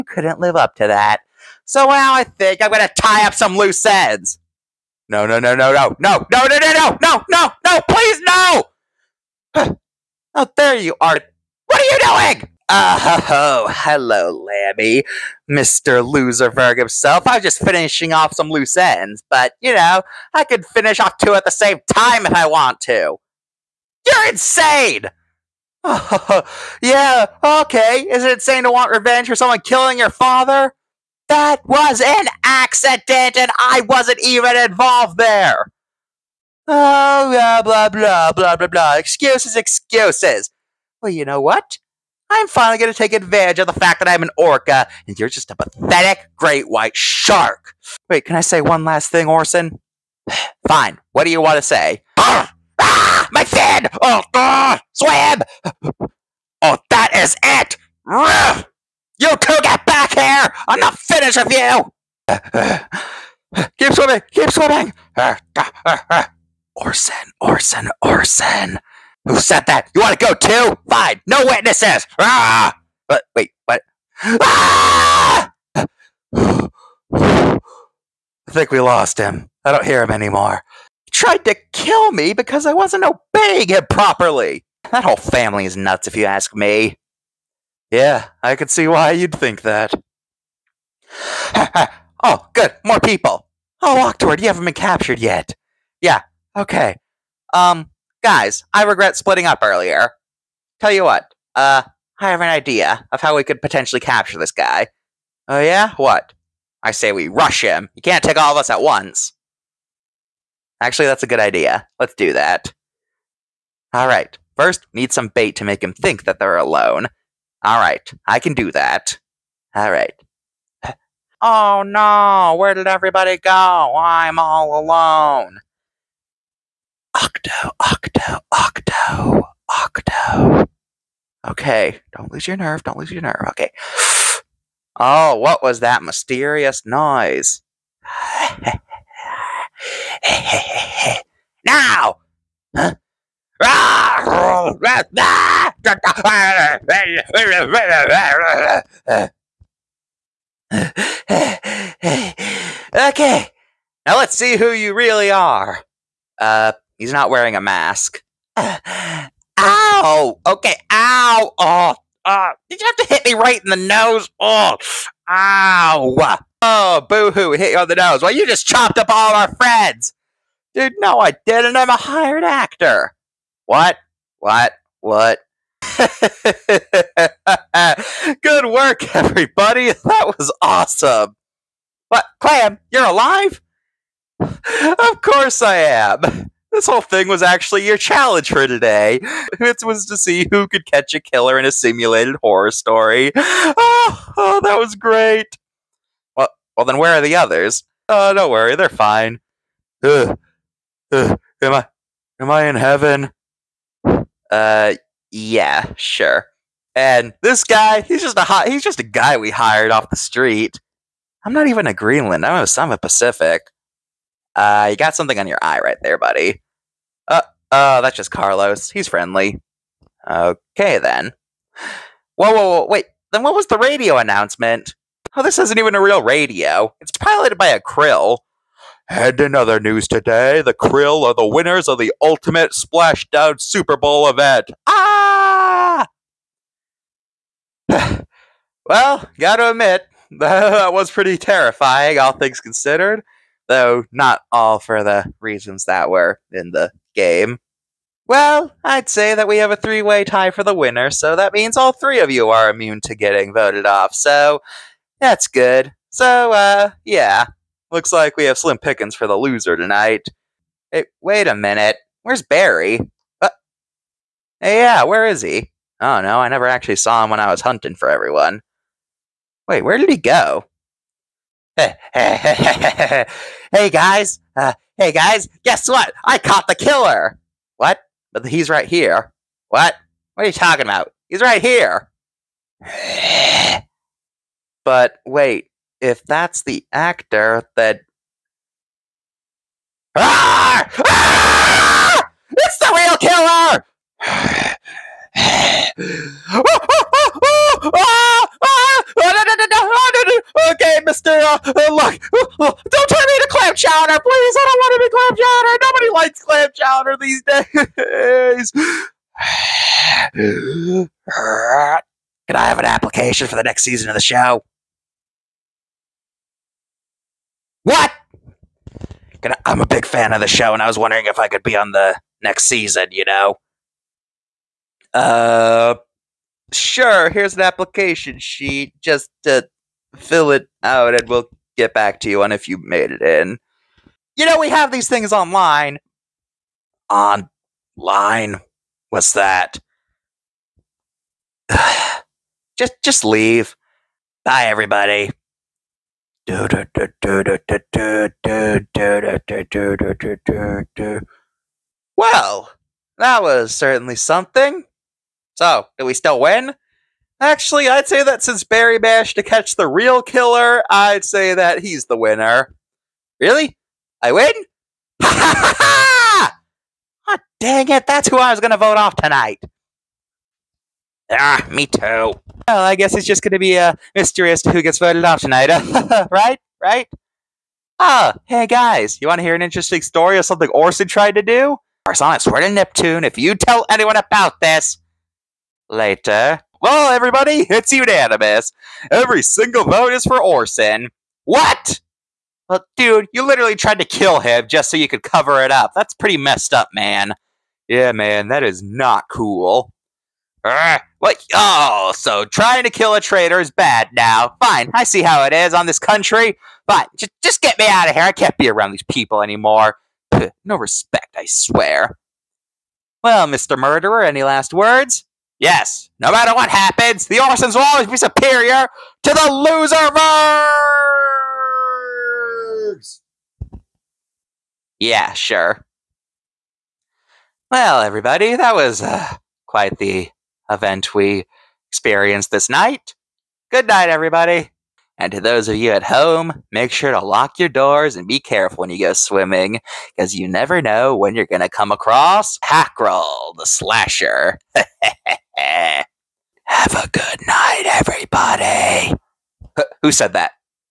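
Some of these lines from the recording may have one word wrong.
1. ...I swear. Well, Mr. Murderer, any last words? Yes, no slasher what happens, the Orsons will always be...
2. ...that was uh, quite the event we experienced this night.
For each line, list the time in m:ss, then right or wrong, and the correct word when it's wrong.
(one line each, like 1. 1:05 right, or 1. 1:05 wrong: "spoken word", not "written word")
1. 6:51 wrong: "matter", not "slasher"
2. 7:08 right.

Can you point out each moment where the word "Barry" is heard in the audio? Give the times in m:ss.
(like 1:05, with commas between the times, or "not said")
4:22, 5:58.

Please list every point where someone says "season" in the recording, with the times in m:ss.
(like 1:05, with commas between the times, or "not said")
5:13, 5:22.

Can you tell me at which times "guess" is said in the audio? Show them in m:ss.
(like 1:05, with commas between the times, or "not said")
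4:35, 6:12.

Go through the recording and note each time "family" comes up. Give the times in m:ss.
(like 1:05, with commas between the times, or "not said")
1:25.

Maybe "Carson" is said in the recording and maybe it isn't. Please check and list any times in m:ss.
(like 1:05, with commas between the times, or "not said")
not said.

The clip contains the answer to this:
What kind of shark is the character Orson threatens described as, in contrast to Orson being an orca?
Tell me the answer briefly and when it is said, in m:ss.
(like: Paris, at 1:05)
Great white shark, at 0:46.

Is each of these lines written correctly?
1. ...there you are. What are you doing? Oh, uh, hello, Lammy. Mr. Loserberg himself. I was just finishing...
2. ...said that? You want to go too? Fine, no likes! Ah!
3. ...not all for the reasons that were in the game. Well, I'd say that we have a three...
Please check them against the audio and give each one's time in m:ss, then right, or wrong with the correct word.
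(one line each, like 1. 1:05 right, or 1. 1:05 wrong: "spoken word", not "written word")
1. 0:10 right
2. 1:09 wrong: "witnesses", not "likes"
3. 4:04 right.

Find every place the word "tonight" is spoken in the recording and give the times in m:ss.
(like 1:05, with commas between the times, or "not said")
4:19, 6:09, 6:15.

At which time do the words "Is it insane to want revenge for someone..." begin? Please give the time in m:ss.
0:28.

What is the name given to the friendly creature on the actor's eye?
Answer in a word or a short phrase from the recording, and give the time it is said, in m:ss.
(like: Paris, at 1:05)
Carlos, at 3:38.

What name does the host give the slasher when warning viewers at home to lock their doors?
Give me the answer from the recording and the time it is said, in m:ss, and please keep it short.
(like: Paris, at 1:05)
Hackrell, at 7:22.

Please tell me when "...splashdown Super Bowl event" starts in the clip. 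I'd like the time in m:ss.
3:52.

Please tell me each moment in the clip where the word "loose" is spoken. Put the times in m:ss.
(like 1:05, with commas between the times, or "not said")
0:03, 0:18.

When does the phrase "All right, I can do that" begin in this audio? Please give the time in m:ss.
1:57.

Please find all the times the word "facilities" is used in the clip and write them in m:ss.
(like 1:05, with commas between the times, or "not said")
not said.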